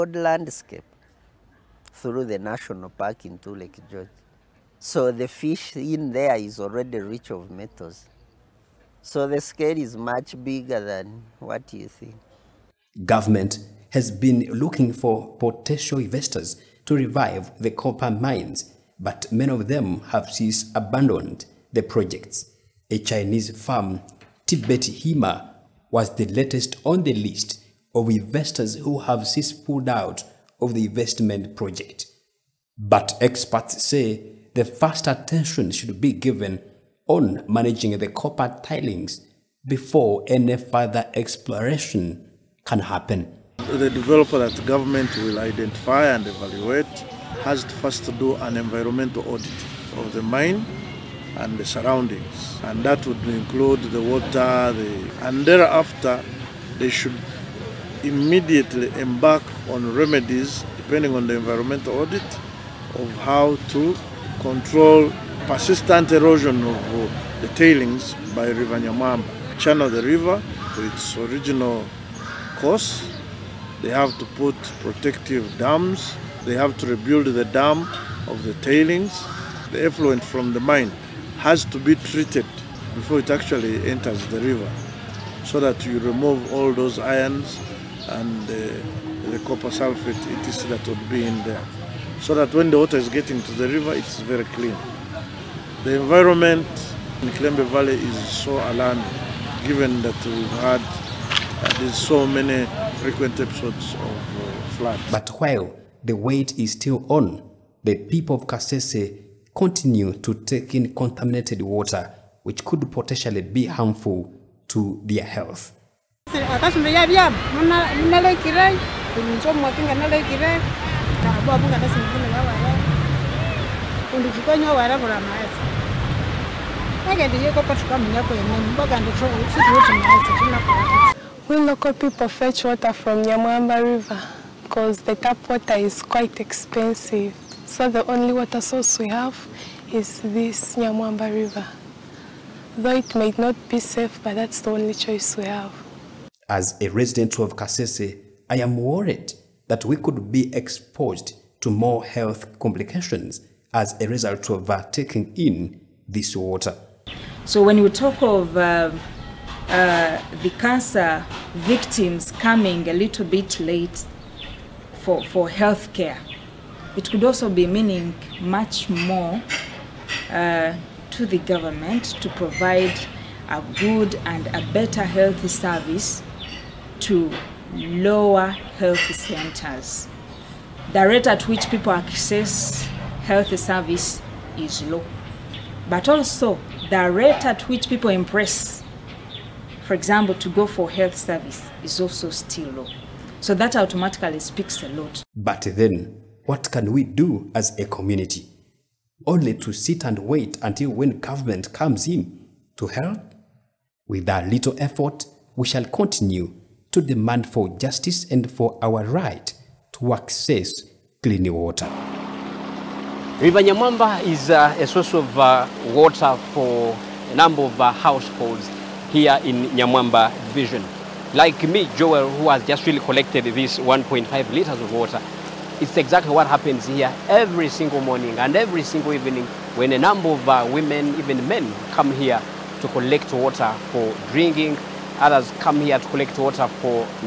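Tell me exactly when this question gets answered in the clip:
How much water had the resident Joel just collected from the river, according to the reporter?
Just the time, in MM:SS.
03:43.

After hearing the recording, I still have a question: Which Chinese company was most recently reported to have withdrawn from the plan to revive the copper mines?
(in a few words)
Tibet Hima.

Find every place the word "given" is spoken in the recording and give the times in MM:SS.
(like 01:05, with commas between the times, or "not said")
00:36, 01:39.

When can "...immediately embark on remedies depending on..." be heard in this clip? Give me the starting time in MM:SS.
00:58.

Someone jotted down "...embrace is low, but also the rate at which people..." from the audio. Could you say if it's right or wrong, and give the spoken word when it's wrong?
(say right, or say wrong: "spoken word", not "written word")
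wrong: "service", not "embrace".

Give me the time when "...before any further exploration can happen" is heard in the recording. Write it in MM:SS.
00:39.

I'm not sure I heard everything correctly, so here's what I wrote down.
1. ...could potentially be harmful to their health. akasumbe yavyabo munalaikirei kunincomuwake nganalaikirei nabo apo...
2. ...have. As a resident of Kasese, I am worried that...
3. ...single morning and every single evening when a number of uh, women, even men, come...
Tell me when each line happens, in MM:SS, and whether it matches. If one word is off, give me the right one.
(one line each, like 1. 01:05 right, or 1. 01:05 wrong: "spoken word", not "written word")
1. 01:52 right
2. 02:25 right
3. 03:47 right.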